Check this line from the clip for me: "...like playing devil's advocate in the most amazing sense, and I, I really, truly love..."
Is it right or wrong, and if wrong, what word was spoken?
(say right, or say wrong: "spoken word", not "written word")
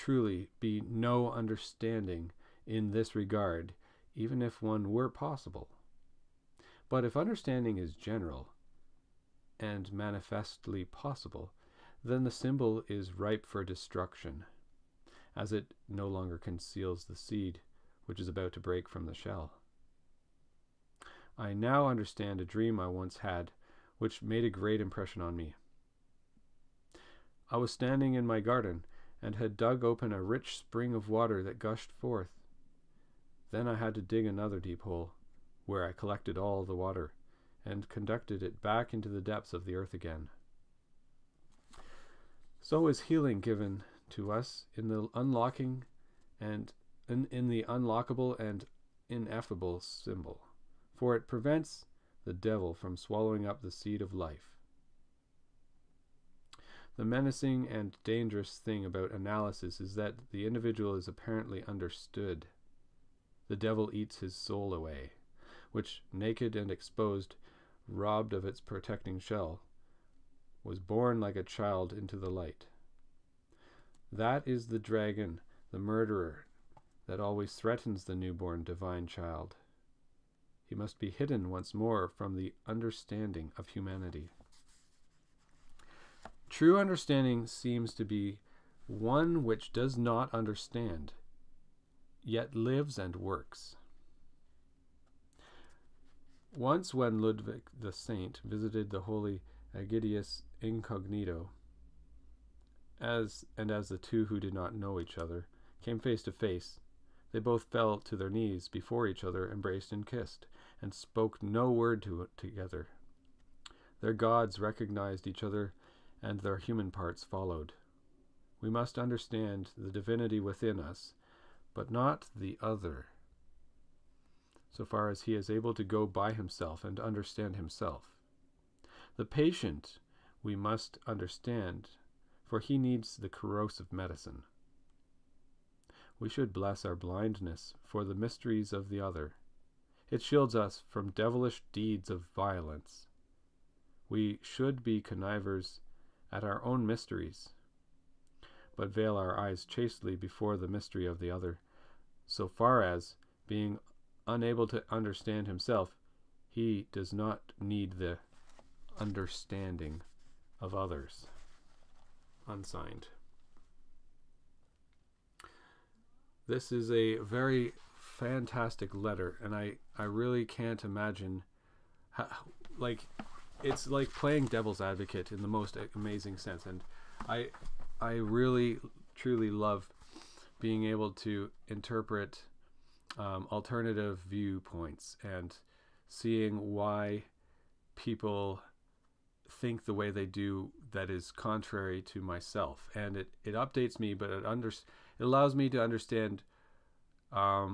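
right.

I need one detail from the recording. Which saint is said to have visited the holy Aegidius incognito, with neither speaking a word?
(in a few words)
Ludwig the Saint.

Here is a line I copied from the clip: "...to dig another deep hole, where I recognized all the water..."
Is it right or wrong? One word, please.
wrong.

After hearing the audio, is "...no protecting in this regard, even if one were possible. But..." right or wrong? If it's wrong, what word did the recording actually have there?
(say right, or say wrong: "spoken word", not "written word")
wrong: "understanding", not "protecting".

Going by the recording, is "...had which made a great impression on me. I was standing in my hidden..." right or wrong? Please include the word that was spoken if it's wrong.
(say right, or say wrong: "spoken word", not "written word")
wrong: "garden", not "hidden".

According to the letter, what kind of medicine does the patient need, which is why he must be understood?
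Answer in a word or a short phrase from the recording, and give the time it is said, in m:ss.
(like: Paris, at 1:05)
Corrosive medicine, at 2:13.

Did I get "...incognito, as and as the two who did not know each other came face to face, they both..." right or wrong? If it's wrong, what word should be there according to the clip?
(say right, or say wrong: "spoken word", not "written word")
right.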